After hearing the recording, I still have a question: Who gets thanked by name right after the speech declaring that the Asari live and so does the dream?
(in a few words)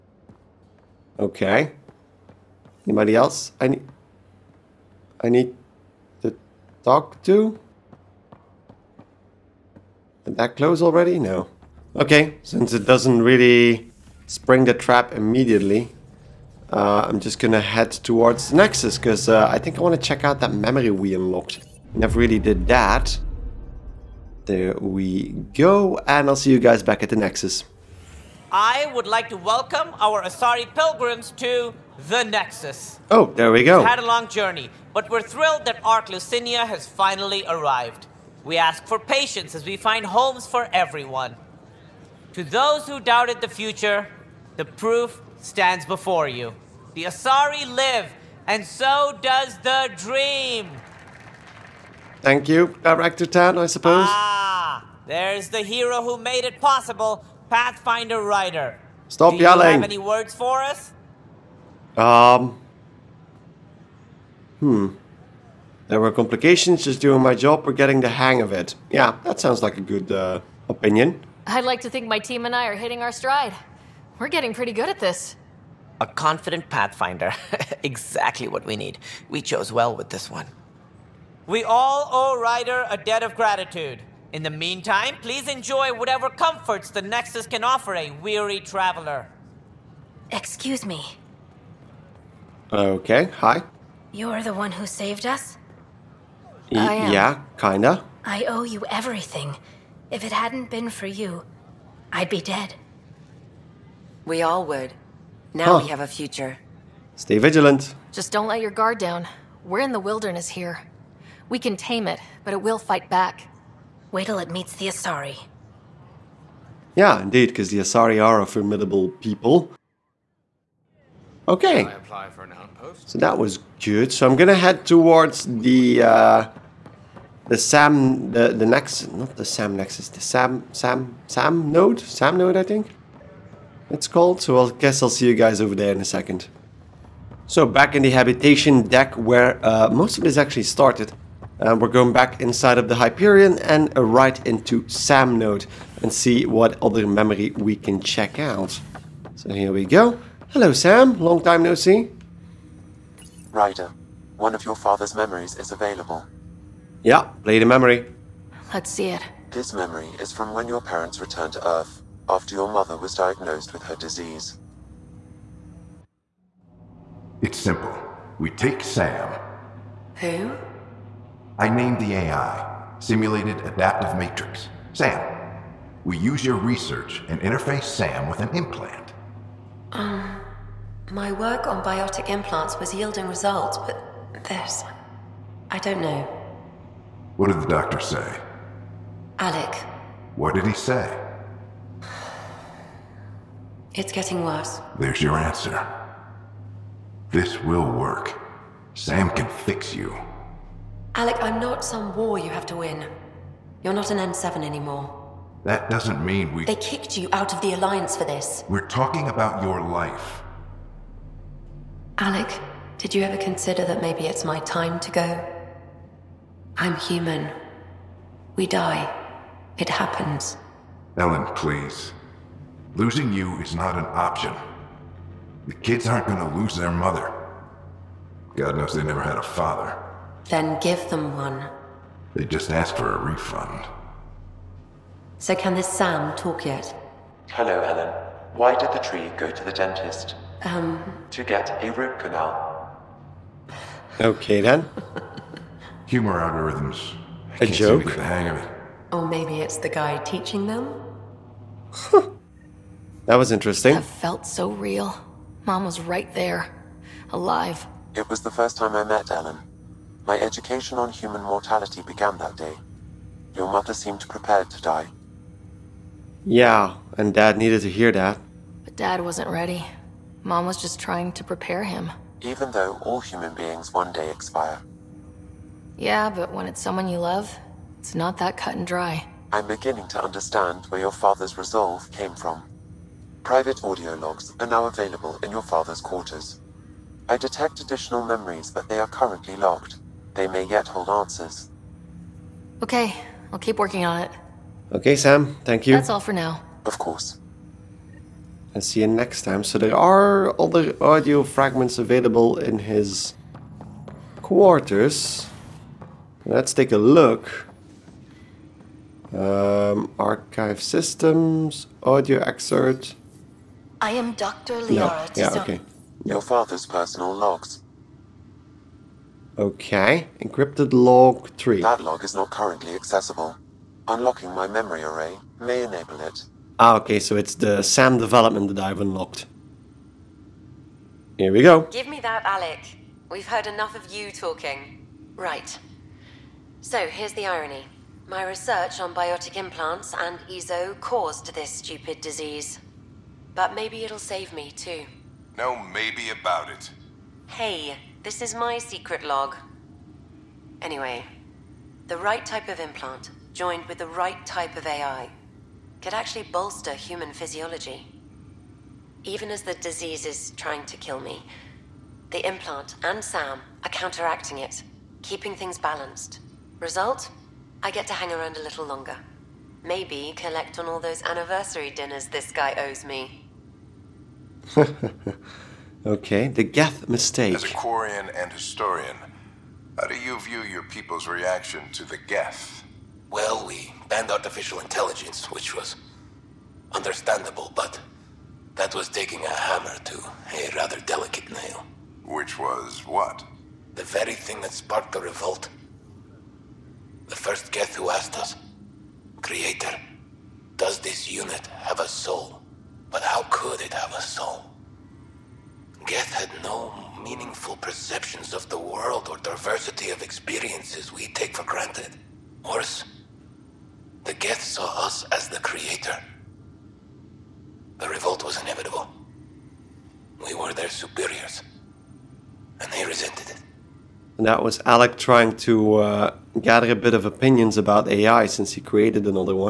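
Director Tann.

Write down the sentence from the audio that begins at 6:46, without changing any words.
Geth had no meaningful perceptions of the world or diversity of experiences we take for granted.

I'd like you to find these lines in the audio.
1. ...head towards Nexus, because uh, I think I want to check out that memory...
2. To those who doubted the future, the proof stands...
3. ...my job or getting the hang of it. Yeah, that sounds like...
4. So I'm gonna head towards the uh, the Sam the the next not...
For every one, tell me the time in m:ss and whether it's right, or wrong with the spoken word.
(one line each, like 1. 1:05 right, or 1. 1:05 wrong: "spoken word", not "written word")
1. 0:17 right
2. 0:42 right
3. 1:07 right
4. 2:04 right.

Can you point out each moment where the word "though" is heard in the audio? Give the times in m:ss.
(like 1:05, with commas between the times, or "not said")
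4:32.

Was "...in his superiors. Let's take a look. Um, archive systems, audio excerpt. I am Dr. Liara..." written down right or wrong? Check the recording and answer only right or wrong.
wrong.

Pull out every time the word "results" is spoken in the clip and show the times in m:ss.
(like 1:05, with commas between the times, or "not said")
3:03, 6:06.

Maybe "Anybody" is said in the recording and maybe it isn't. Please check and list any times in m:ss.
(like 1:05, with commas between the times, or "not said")
0:02.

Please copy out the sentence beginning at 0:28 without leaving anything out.
I would like to welcome our Asari pilgrims to the Nexus.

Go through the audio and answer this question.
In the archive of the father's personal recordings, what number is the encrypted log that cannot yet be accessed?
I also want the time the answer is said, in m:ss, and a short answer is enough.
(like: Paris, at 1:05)
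3, at 5:21.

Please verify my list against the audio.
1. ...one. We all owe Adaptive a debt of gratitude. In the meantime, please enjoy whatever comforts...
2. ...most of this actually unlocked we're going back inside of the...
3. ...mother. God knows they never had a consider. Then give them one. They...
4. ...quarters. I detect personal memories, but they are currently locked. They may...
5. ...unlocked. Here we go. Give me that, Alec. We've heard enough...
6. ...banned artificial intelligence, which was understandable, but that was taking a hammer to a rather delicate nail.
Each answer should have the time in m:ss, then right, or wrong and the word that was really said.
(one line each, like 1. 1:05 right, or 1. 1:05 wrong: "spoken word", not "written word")
1. 1:20 wrong: "Ryder", not "Adaptive"
2. 2:19 wrong: "started", not "unlocked"
3. 3:46 wrong: "father", not "consider"
4. 4:46 wrong: "additional", not "personal"
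5. 5:29 right
6. 6:24 right.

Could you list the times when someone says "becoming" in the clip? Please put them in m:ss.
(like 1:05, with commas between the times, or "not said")
not said.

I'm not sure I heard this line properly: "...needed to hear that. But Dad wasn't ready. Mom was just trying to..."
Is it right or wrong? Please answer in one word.
right.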